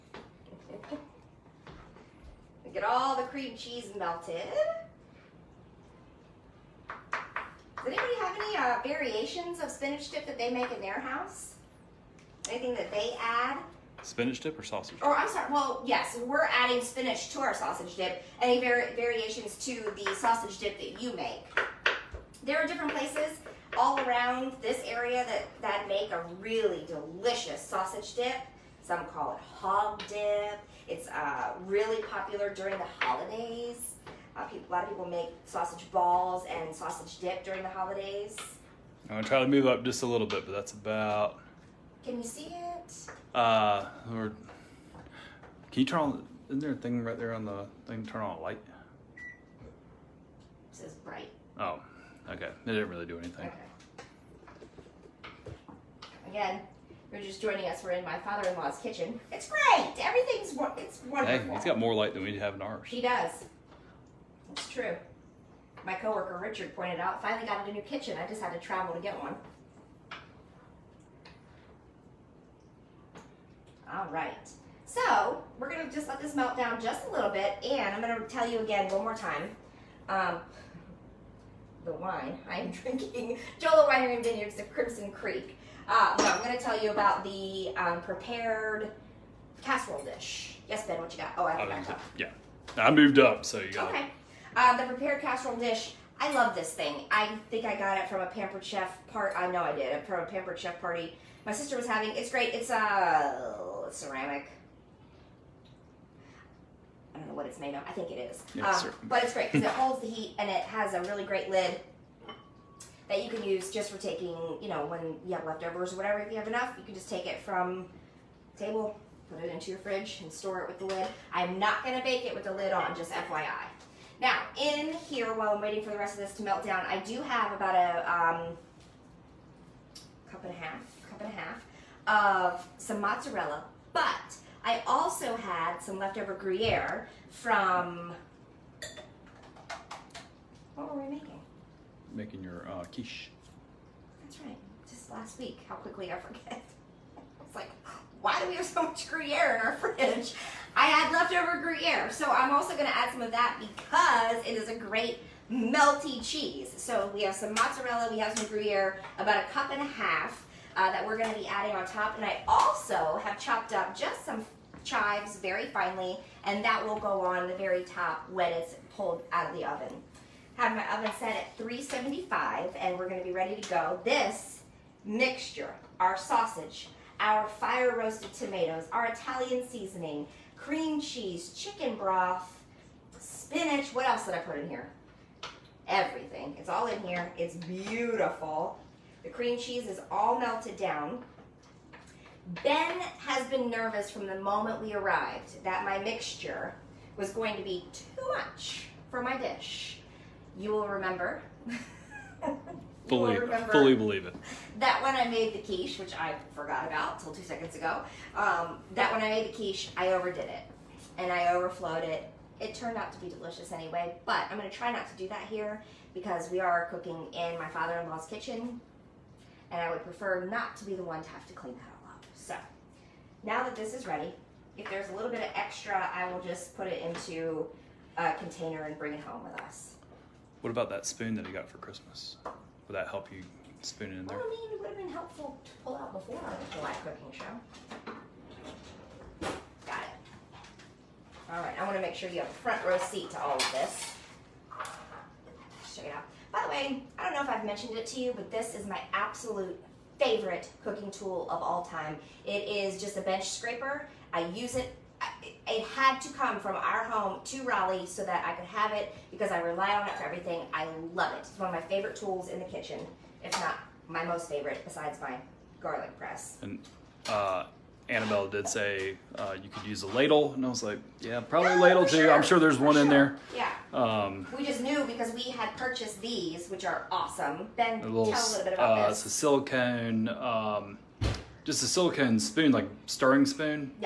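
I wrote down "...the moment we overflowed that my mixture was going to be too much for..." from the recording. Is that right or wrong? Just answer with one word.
wrong.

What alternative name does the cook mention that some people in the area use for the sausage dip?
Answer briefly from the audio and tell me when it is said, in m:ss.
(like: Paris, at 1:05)
Hog dip, at 0:29.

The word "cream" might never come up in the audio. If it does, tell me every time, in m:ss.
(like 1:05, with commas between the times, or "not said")
0:03, 3:00, 3:09.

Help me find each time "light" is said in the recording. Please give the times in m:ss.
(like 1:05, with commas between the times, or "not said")
0:48, 1:01.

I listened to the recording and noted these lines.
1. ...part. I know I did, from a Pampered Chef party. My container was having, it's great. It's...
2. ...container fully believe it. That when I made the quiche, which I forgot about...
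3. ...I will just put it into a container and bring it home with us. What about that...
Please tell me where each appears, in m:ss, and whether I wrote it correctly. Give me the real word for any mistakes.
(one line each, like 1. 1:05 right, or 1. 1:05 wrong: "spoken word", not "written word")
1. 1:39 wrong: "sister", not "container"
2. 3:23 wrong: "remember", not "container"
3. 3:46 right.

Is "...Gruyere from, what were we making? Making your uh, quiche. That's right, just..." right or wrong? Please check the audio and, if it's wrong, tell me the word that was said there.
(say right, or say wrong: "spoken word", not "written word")
right.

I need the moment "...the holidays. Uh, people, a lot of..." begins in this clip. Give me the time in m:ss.
0:32.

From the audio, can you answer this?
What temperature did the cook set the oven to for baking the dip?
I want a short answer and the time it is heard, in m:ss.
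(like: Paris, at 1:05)
375, at 2:51.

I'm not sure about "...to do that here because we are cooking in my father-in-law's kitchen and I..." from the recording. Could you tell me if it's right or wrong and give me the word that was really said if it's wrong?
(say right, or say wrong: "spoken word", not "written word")
right.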